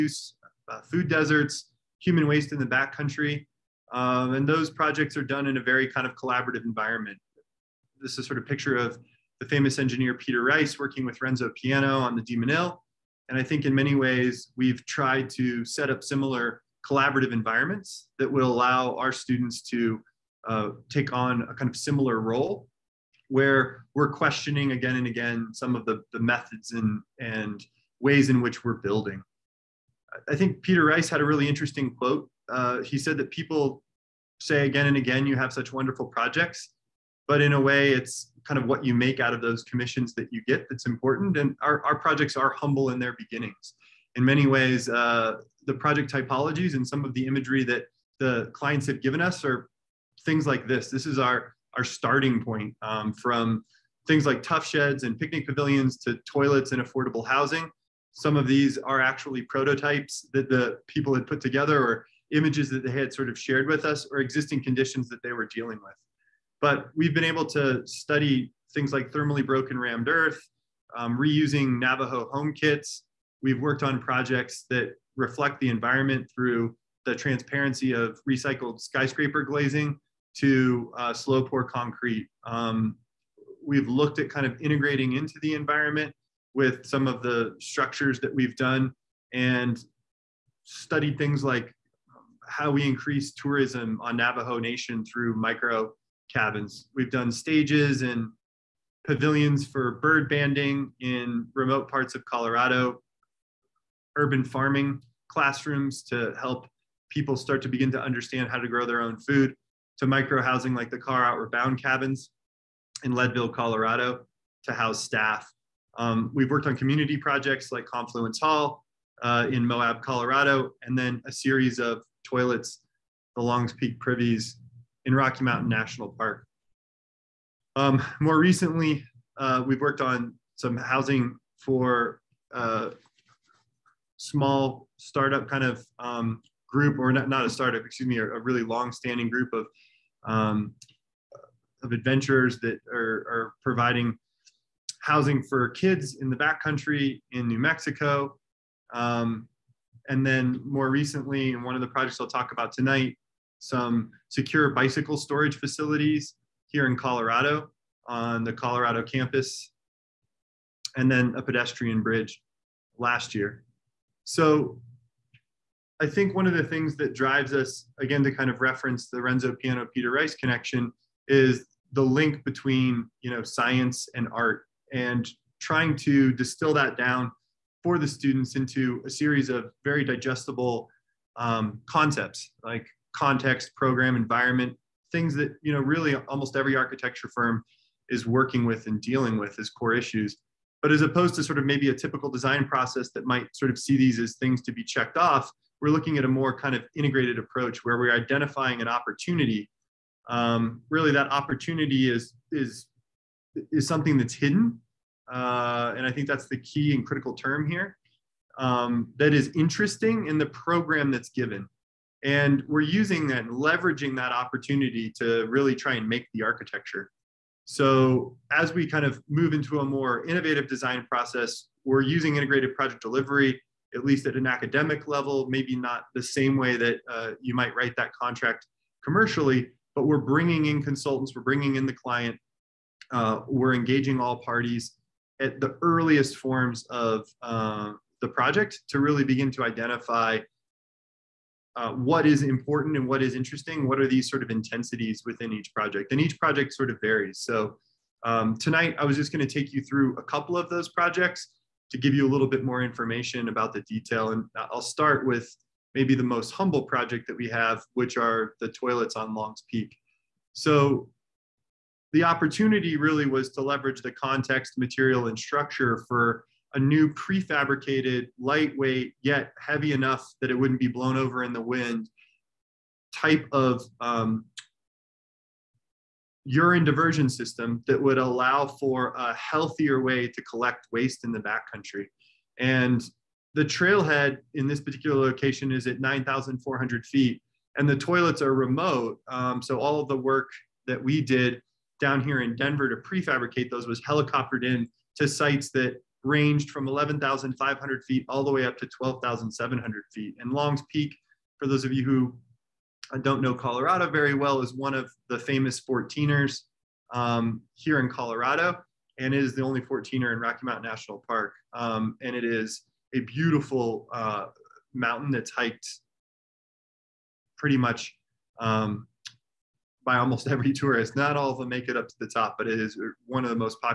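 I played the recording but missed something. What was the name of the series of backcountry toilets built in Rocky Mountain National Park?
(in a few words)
Longs Peak Privies.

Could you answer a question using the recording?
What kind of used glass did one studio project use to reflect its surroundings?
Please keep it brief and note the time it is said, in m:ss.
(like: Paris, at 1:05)
recycled skyscraper glazing, at 1:18.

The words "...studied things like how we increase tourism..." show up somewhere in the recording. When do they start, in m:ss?
1:30.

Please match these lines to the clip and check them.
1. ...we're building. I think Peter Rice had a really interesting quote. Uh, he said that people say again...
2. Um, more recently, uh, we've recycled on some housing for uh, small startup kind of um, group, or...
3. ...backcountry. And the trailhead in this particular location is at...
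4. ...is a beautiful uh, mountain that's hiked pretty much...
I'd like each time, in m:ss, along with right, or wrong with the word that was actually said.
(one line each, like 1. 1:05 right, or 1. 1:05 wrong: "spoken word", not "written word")
1. 0:28 right
2. 2:07 wrong: "worked", not "recycled"
3. 4:41 right
4. 5:12 right.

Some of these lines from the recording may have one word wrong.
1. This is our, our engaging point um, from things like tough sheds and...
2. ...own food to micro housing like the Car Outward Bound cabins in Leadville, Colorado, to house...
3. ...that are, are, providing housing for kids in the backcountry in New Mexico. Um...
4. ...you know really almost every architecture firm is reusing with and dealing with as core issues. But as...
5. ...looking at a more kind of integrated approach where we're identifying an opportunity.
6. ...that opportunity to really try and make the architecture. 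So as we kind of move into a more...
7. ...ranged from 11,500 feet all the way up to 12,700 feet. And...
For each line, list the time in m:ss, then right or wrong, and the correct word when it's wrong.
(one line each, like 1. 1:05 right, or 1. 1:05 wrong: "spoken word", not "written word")
1. 0:50 wrong: "starting", not "engaging"
2. 1:49 right
3. 2:22 right
4. 3:05 wrong: "working", not "reusing"
5. 3:15 right
6. 3:34 right
7. 4:56 right.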